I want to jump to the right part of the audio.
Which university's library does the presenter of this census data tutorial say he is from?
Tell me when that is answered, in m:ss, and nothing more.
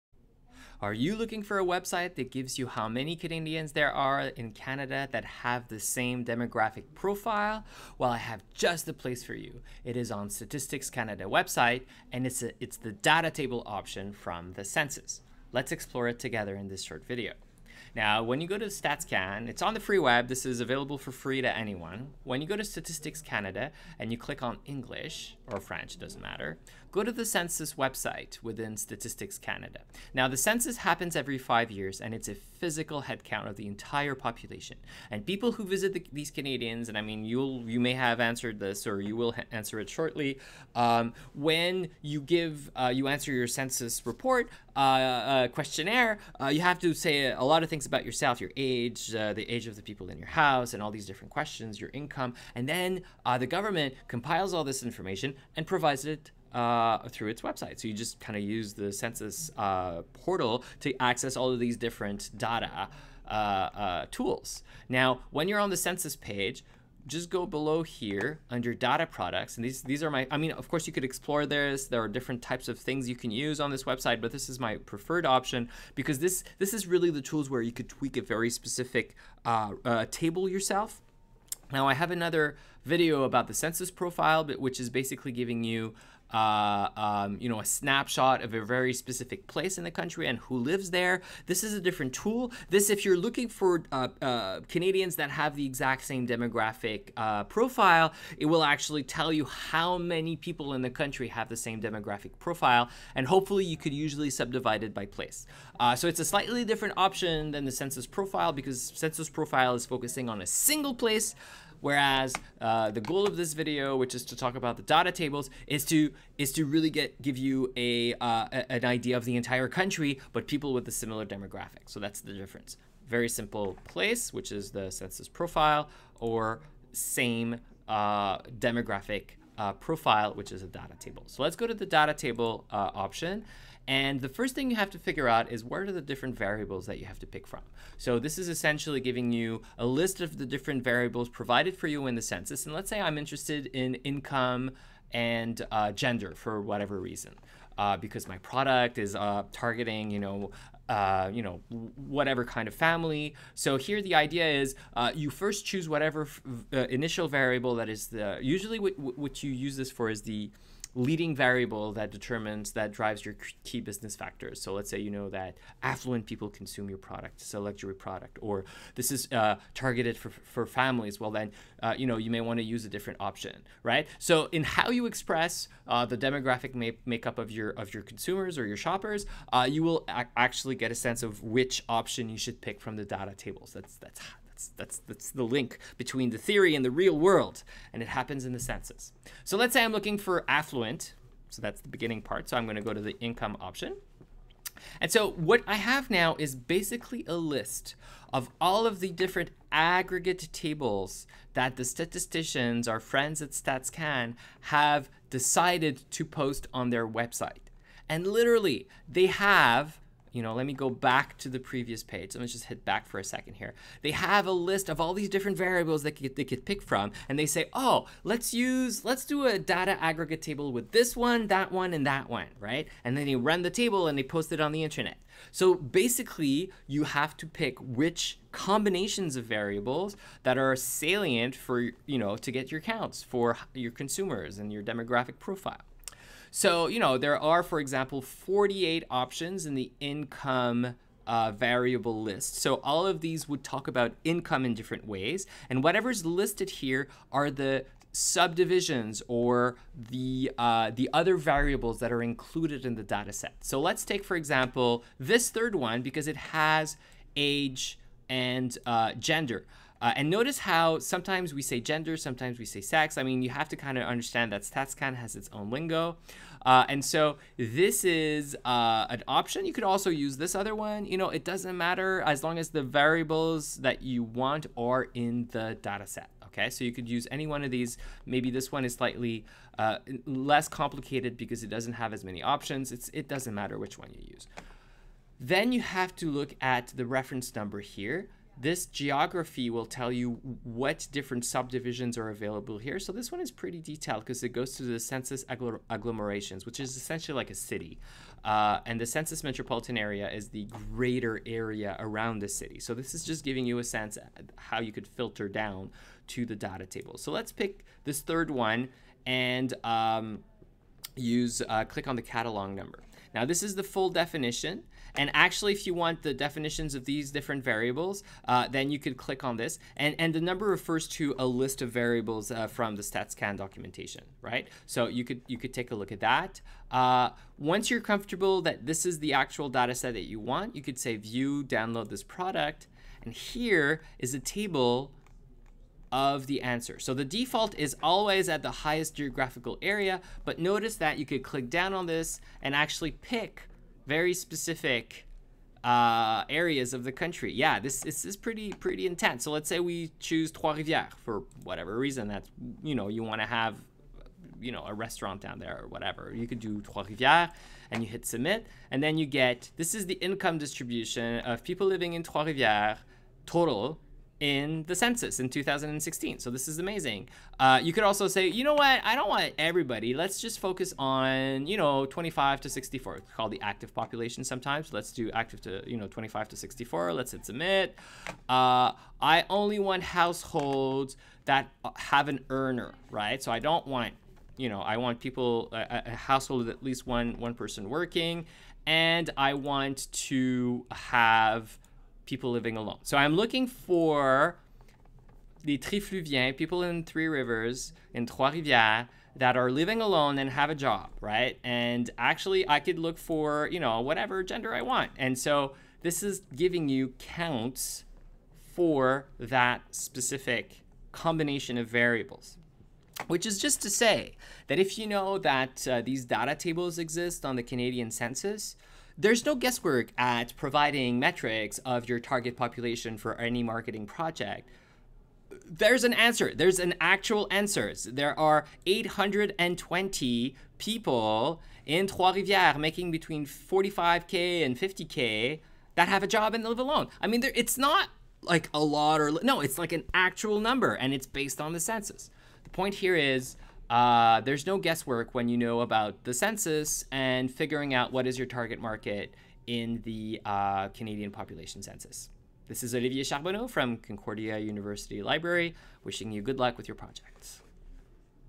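7:33.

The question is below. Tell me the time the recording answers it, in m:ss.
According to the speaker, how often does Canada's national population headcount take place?
0:31.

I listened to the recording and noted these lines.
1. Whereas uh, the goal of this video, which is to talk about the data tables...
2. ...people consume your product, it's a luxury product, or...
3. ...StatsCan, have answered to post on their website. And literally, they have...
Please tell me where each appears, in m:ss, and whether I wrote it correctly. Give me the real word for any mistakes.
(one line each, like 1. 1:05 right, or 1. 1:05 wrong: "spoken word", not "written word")
1. 1:51 right
2. 2:46 right
3. 3:23 wrong: "decided", not "answered".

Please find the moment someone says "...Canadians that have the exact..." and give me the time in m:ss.
1:34.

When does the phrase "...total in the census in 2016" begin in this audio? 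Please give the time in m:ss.
6:03.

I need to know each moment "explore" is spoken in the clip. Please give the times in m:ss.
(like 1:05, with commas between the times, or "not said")
0:15, 1:11.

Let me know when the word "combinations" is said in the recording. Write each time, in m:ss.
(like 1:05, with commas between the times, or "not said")
3:48, 6:51.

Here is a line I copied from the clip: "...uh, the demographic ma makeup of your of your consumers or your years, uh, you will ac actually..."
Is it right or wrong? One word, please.
wrong.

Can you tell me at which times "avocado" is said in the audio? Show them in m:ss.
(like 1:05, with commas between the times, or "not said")
not said.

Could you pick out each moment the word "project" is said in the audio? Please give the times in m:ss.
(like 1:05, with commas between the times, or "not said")
7:04, 7:36.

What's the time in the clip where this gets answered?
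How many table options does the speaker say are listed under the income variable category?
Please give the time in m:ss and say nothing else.
3:58.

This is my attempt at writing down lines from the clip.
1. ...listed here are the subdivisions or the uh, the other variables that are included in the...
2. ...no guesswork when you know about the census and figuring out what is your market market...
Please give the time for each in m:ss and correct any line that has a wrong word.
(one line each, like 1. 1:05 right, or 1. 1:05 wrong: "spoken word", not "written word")
1. 4:06 right
2. 7:24 wrong: "target", not "market".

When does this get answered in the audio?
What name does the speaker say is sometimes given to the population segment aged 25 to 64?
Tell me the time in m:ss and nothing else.
6:13.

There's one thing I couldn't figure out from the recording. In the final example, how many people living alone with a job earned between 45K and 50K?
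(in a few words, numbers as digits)
820.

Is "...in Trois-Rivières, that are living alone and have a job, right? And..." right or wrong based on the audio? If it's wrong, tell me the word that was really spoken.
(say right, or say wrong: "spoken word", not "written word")
right.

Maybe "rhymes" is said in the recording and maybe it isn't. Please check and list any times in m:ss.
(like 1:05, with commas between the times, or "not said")
not said.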